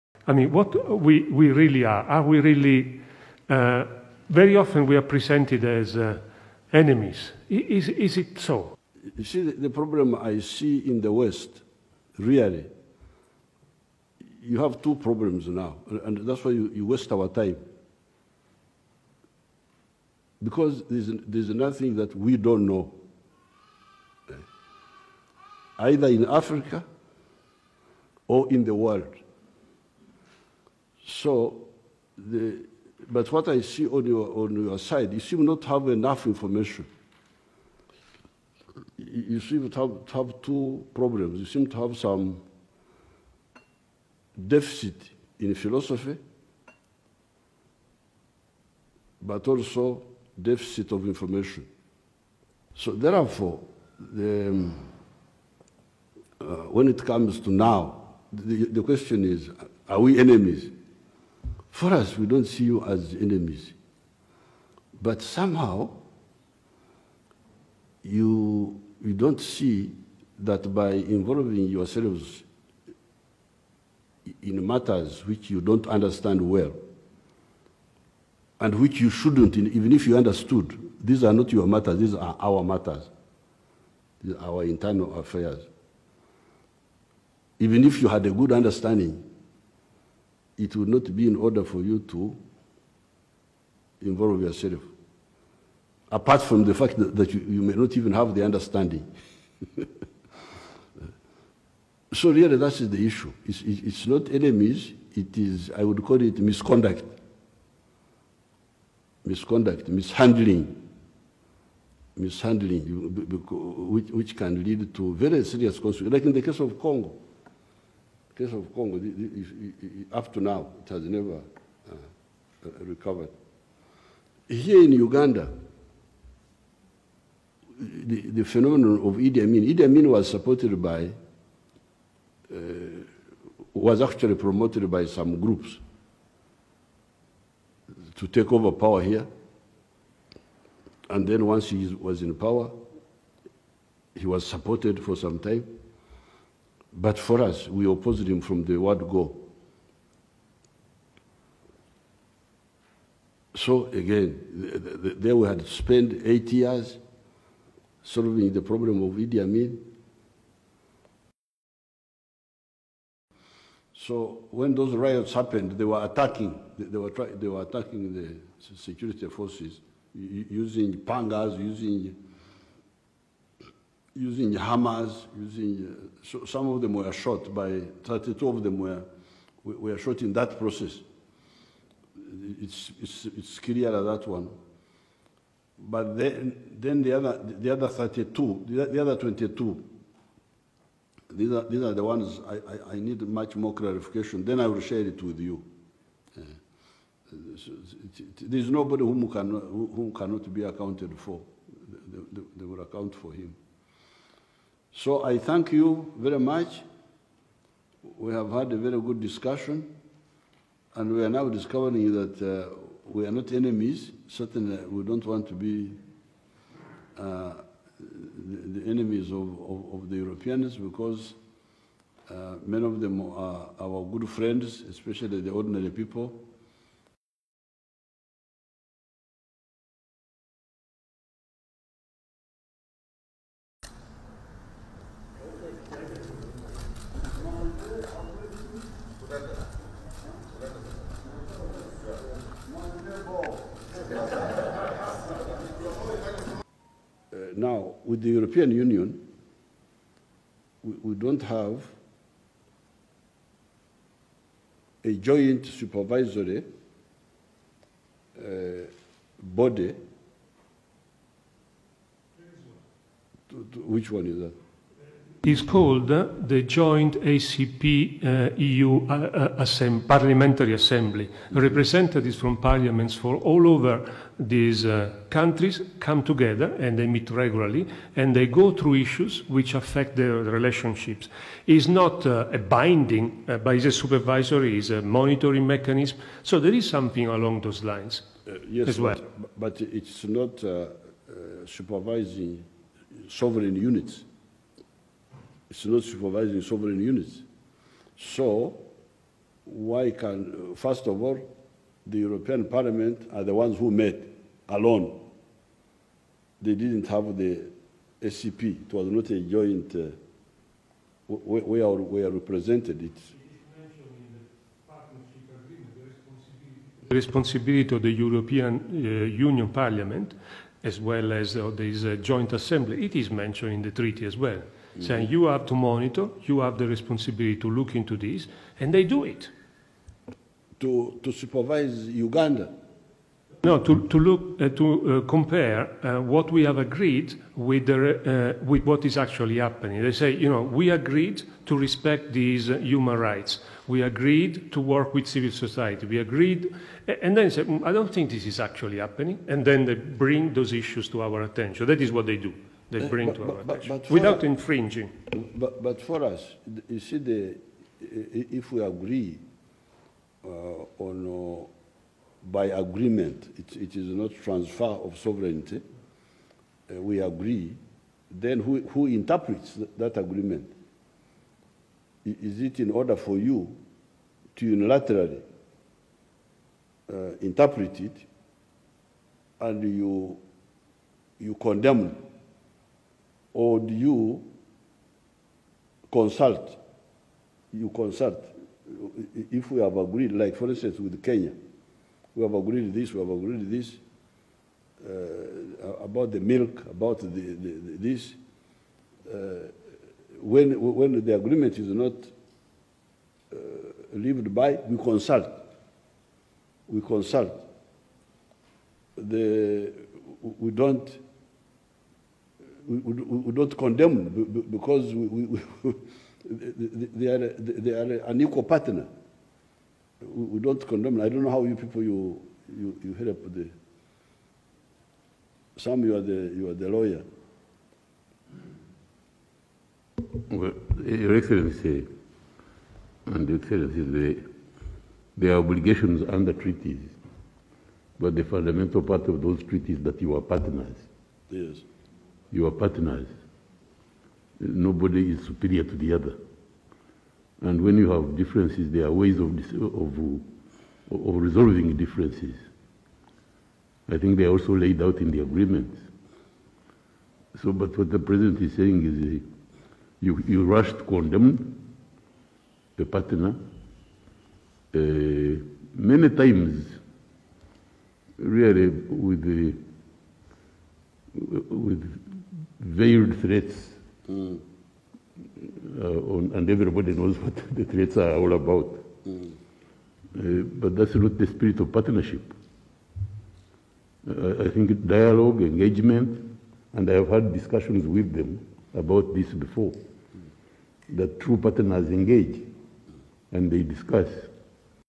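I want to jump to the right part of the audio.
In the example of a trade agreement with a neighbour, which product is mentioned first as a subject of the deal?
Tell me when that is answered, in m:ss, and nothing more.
6:36.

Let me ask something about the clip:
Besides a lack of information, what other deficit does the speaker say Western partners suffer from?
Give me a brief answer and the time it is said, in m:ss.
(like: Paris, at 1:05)
Philosophy, at 0:45.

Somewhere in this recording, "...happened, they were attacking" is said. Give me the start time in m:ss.
2:45.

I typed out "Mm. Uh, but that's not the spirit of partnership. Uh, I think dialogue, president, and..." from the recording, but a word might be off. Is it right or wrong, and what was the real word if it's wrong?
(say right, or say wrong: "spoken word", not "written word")
wrong: "engagement", not "president".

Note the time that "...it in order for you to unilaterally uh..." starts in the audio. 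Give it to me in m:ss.
6:12.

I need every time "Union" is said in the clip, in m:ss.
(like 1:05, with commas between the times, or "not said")
4:08, 5:19.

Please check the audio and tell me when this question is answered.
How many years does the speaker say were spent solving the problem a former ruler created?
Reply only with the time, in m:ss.
2:36.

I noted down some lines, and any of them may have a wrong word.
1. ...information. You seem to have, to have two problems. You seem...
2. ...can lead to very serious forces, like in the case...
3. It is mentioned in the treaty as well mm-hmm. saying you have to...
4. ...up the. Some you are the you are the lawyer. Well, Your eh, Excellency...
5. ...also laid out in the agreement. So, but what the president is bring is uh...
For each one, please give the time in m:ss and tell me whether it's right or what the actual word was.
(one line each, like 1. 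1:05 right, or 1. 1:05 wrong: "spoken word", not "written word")
1. 0:36 right
2. 1:54 wrong: "consequences", not "forces"
3. 5:23 right
4. 7:03 right
5. 7:34 wrong: "saying", not "bring".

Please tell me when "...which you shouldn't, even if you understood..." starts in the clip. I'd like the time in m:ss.
1:18.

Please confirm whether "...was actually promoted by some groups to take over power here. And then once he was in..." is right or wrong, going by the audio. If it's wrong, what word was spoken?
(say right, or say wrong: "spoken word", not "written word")
right.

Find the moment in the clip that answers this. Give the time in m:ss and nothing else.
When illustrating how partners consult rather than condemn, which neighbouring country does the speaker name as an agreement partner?
6:31.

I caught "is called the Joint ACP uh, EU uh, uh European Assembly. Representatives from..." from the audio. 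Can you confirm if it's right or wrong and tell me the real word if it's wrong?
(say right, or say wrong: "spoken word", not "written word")
wrong: "Parliamentary", not "European".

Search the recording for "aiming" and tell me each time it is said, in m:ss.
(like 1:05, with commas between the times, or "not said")
not said.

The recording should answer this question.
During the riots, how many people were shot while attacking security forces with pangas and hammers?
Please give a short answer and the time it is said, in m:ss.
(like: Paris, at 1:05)
32, at 2:58.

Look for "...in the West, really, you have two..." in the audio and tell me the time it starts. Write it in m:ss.
0:10.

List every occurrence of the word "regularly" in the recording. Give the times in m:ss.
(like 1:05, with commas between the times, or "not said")
4:37.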